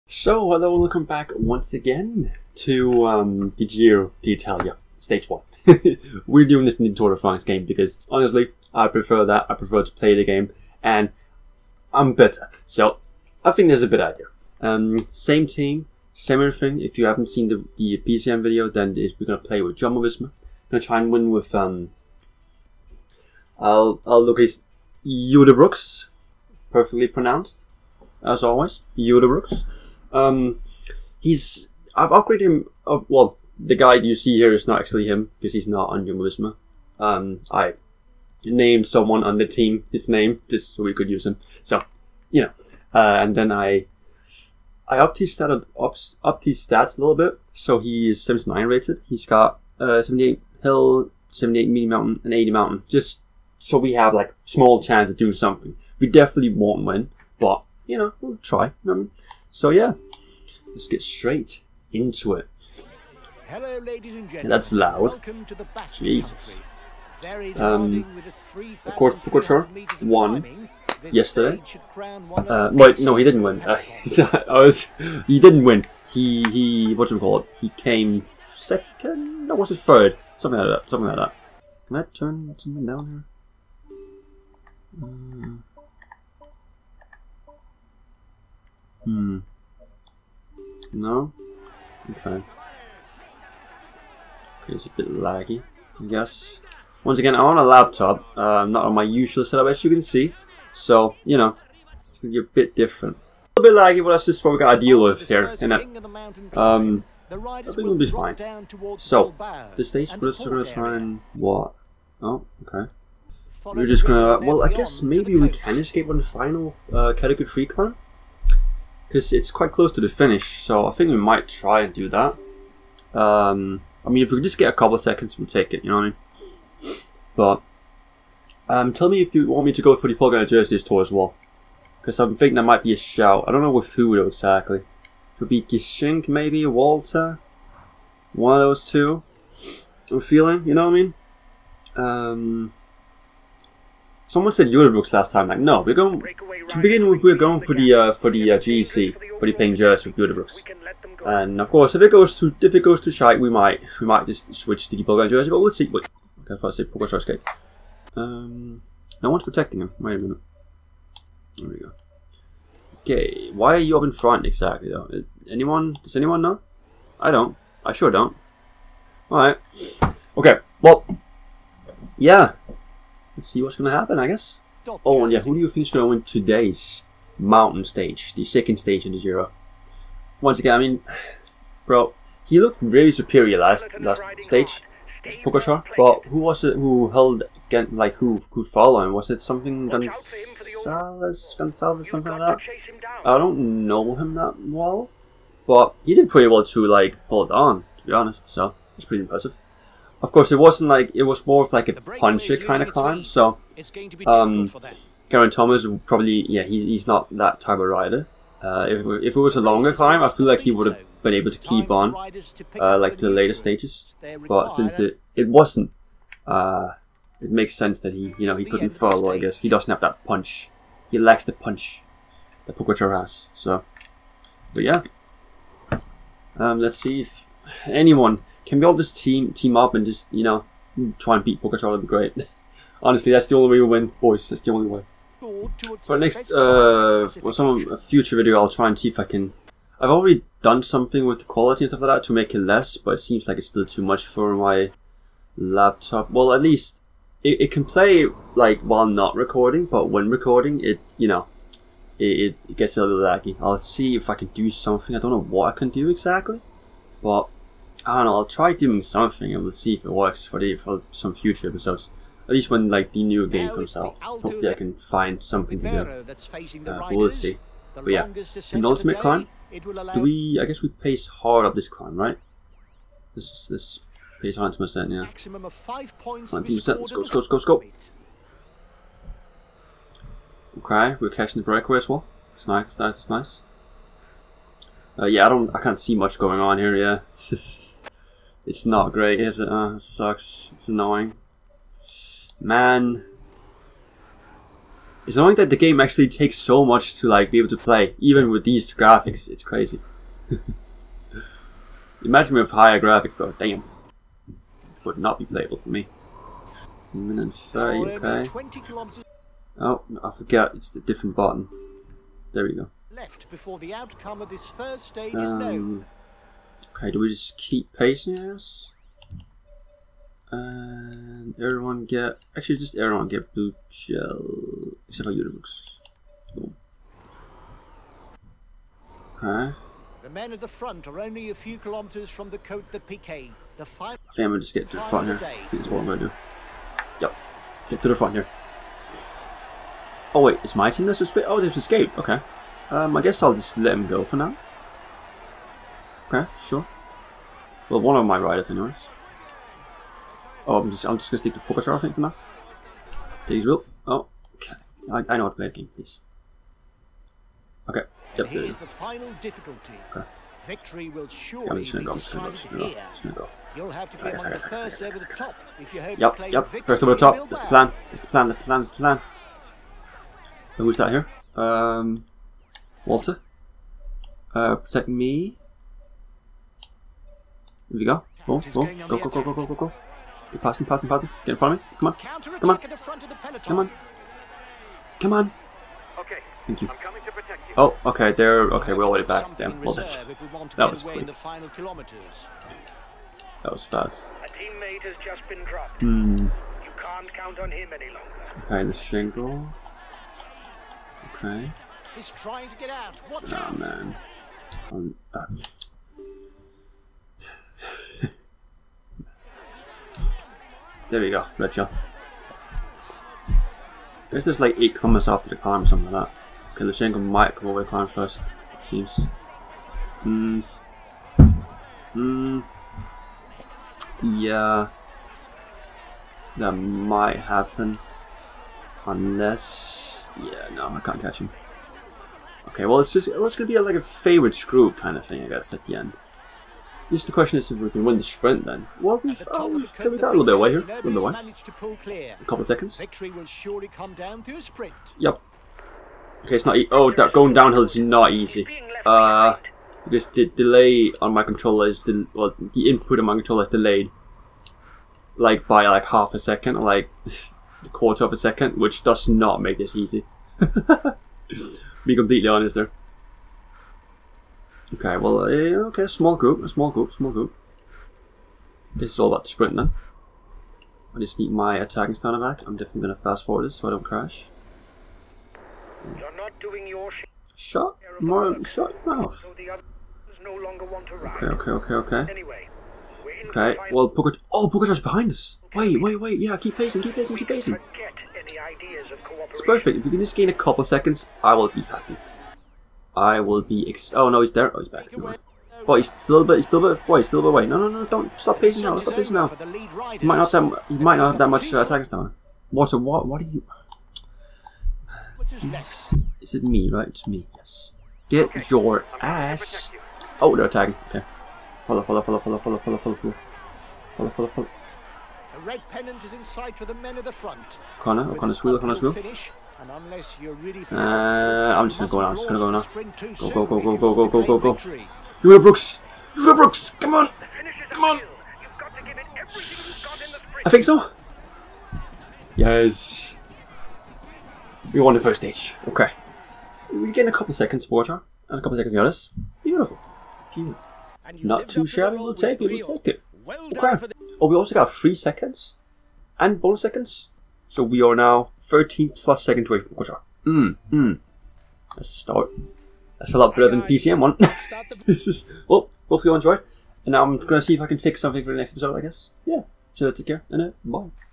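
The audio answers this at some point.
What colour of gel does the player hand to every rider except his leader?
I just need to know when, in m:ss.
5:23.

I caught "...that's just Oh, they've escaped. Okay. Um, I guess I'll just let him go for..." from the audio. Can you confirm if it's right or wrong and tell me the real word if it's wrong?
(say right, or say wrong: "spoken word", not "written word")
right.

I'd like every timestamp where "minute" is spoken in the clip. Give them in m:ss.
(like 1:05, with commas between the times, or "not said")
2:40, 5:07.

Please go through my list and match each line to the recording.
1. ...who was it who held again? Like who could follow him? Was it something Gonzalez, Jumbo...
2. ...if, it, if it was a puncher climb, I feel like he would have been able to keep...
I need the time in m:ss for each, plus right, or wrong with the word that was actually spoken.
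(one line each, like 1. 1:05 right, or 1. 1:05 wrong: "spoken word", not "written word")
1. 3:06 wrong: "Gonzalez", not "Jumbo"
2. 3:28 wrong: "longer", not "puncher".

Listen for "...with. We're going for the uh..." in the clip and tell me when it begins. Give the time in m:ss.
2:27.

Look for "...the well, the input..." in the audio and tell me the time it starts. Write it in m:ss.
7:32.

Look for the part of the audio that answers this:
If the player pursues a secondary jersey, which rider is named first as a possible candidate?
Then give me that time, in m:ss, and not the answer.
2:15.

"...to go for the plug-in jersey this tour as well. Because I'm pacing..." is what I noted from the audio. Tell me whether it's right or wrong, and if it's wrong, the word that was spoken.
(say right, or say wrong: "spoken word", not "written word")
wrong: "thinking", not "pacing".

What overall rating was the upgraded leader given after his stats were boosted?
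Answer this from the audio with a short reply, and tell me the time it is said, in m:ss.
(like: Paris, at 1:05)
79, at 0:48.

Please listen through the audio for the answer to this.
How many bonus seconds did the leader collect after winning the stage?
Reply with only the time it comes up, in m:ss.
9:04.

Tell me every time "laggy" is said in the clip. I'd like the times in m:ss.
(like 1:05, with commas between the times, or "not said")
1:35, 1:43, 4:13.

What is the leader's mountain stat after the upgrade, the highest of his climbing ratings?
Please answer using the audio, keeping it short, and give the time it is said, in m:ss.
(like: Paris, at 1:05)
80, at 0:52.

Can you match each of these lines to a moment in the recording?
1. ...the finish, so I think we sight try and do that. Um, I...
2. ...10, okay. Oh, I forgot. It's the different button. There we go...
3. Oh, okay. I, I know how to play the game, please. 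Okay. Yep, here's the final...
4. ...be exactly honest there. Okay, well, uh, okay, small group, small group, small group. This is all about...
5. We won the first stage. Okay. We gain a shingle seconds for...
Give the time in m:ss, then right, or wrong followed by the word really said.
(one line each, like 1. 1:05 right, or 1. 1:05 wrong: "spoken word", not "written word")
1. 2:00 wrong: "might", not "sight"
2. 5:07 wrong: "30", not "10"
3. 5:54 right
4. 7:42 wrong: "completely", not "exactly"
5. 8:54 wrong: "couple", not "shingle".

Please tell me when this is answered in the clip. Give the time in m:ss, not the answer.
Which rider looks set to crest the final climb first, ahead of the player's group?
6:56.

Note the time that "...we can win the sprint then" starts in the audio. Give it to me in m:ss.
7:17.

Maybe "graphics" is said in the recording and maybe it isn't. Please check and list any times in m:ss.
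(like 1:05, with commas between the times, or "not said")
4:58, 5:02.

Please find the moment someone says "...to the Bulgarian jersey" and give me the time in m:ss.
2:34.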